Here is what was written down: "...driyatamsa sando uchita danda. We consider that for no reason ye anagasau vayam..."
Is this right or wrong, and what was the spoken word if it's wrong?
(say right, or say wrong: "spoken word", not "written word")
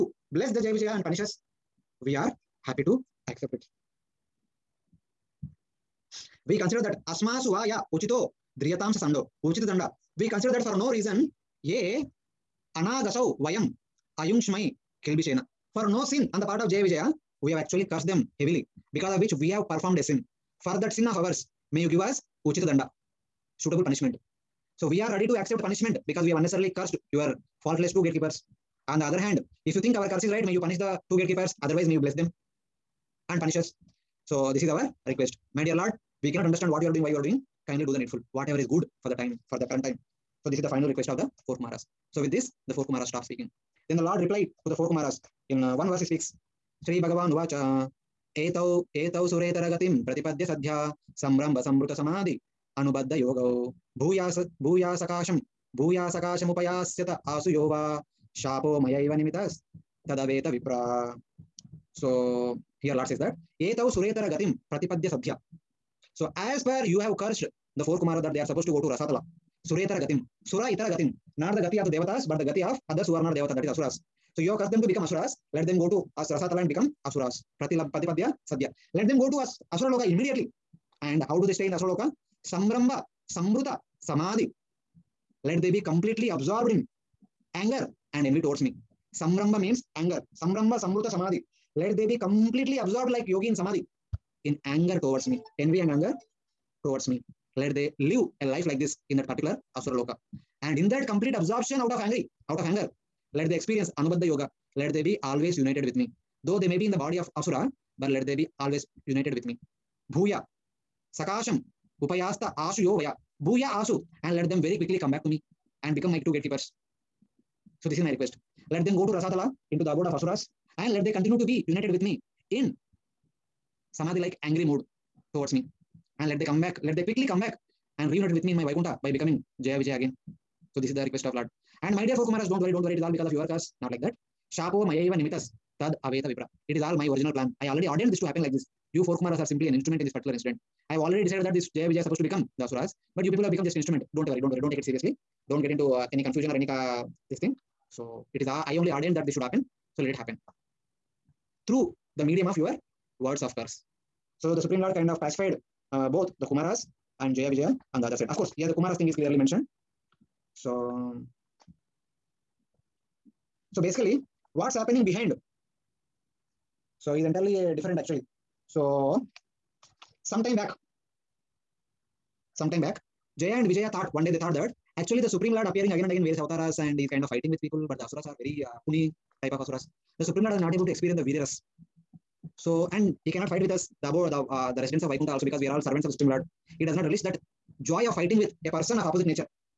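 right.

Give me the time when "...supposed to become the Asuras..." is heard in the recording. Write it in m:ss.
2:22.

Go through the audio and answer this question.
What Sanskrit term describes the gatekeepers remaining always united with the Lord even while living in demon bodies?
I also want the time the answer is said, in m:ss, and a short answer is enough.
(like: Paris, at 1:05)
Anubandha Yoga, at 1:43.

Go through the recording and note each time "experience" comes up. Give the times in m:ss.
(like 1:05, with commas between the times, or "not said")
1:43, 3:00.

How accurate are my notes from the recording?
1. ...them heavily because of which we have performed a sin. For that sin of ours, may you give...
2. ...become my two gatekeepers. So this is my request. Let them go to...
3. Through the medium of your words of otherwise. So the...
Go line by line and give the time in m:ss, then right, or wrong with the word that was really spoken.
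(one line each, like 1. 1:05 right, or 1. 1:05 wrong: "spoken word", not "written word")
1. 0:18 right
2. 1:55 right
3. 2:31 wrong: "curse", not "otherwise".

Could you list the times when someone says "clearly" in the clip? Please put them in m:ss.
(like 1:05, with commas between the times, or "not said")
2:39.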